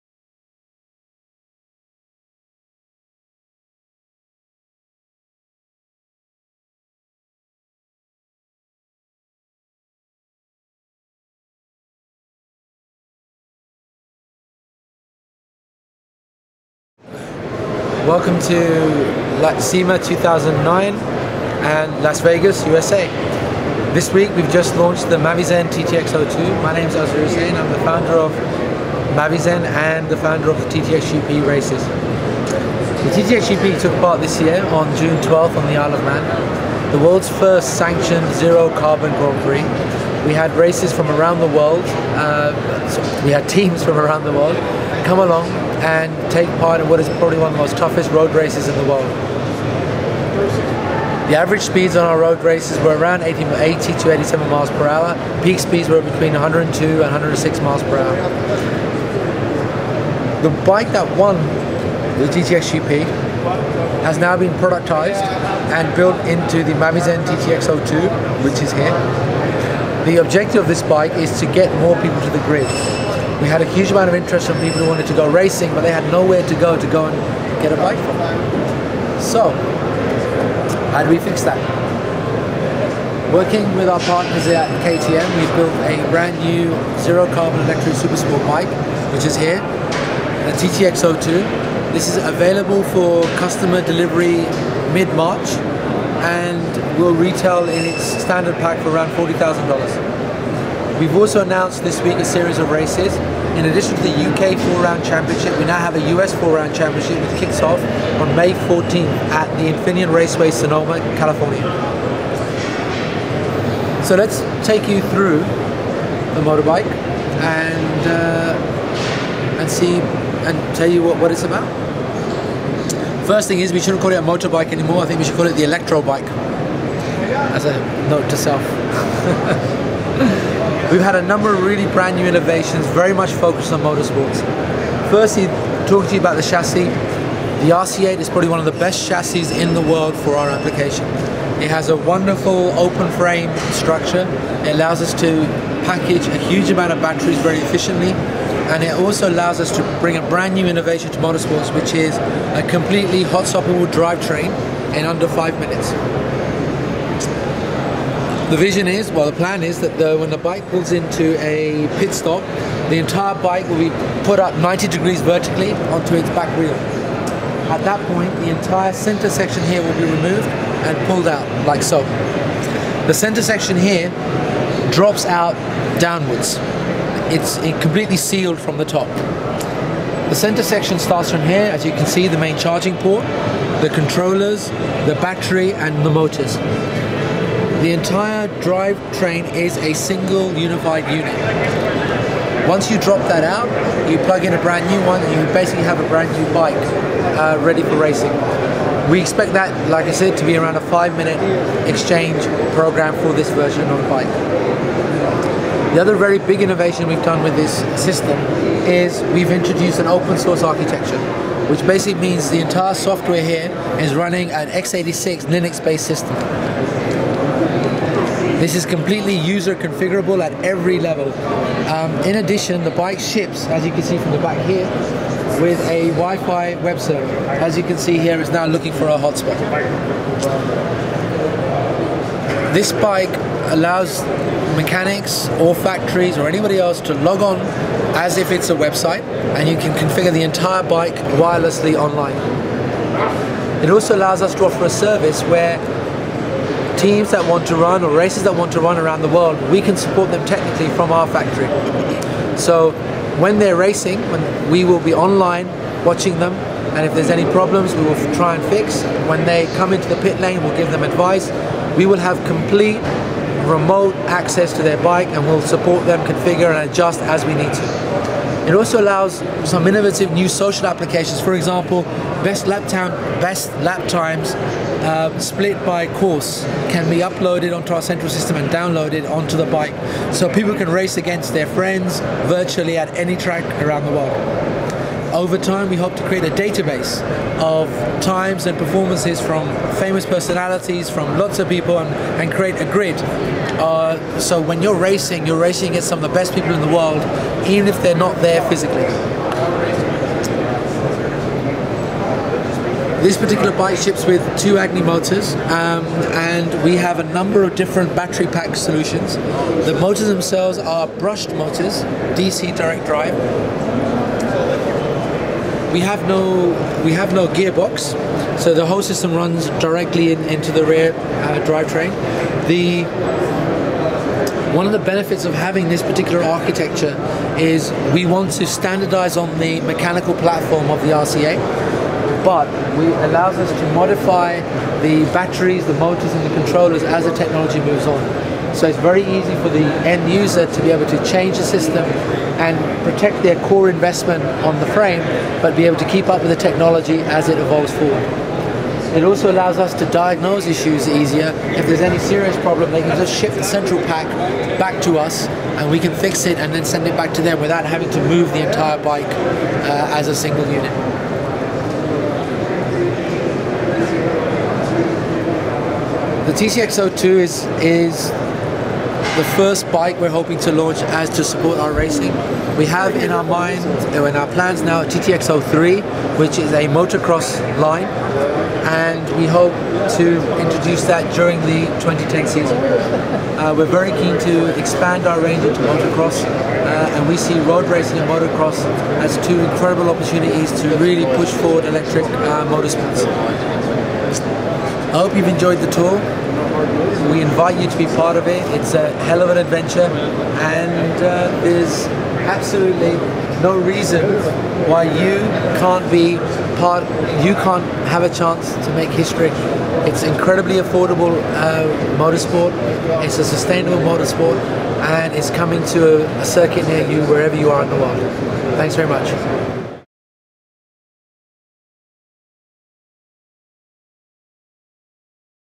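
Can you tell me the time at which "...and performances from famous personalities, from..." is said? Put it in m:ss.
4:48.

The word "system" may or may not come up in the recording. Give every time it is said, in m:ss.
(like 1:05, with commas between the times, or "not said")
3:28, 3:36, 4:38, 5:19, 5:41.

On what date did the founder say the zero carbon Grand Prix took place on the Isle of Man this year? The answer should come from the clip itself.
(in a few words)
June 12th.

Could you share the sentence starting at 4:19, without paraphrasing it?
When they come into the pit lane we'll give them advice.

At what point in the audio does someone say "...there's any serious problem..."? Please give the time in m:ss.
5:51.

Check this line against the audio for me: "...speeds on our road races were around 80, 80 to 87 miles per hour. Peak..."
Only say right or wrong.
right.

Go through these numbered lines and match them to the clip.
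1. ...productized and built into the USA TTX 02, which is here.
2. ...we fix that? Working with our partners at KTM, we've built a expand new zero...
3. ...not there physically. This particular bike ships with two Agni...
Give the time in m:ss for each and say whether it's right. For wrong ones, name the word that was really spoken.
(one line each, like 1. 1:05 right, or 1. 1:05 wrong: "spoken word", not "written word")
1. 1:04 wrong: "Mavizen", not "USA"
2. 1:21 wrong: "brand", not "expand"
3. 4:58 right.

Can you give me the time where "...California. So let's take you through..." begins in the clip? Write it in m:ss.
1:51.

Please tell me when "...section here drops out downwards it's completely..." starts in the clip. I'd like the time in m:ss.
2:53.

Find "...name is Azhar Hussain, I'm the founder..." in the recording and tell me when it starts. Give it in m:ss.
0:26.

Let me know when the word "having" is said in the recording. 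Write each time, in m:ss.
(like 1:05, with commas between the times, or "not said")
5:25, 5:57.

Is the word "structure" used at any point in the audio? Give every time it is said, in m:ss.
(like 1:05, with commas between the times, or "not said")
2:23.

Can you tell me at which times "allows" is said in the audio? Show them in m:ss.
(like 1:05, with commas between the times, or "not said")
2:24, 2:29, 3:53, 4:04, 4:29, 5:33, 5:49.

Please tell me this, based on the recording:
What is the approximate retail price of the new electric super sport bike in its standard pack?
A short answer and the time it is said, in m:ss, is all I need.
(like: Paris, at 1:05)
$40,000, at 1:39.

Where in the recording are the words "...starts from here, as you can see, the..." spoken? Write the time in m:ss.
3:00.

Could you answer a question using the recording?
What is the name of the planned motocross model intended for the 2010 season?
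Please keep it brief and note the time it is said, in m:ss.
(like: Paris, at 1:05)
TTX 03, at 6:15.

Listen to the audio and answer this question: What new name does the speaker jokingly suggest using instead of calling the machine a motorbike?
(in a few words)
electro bike.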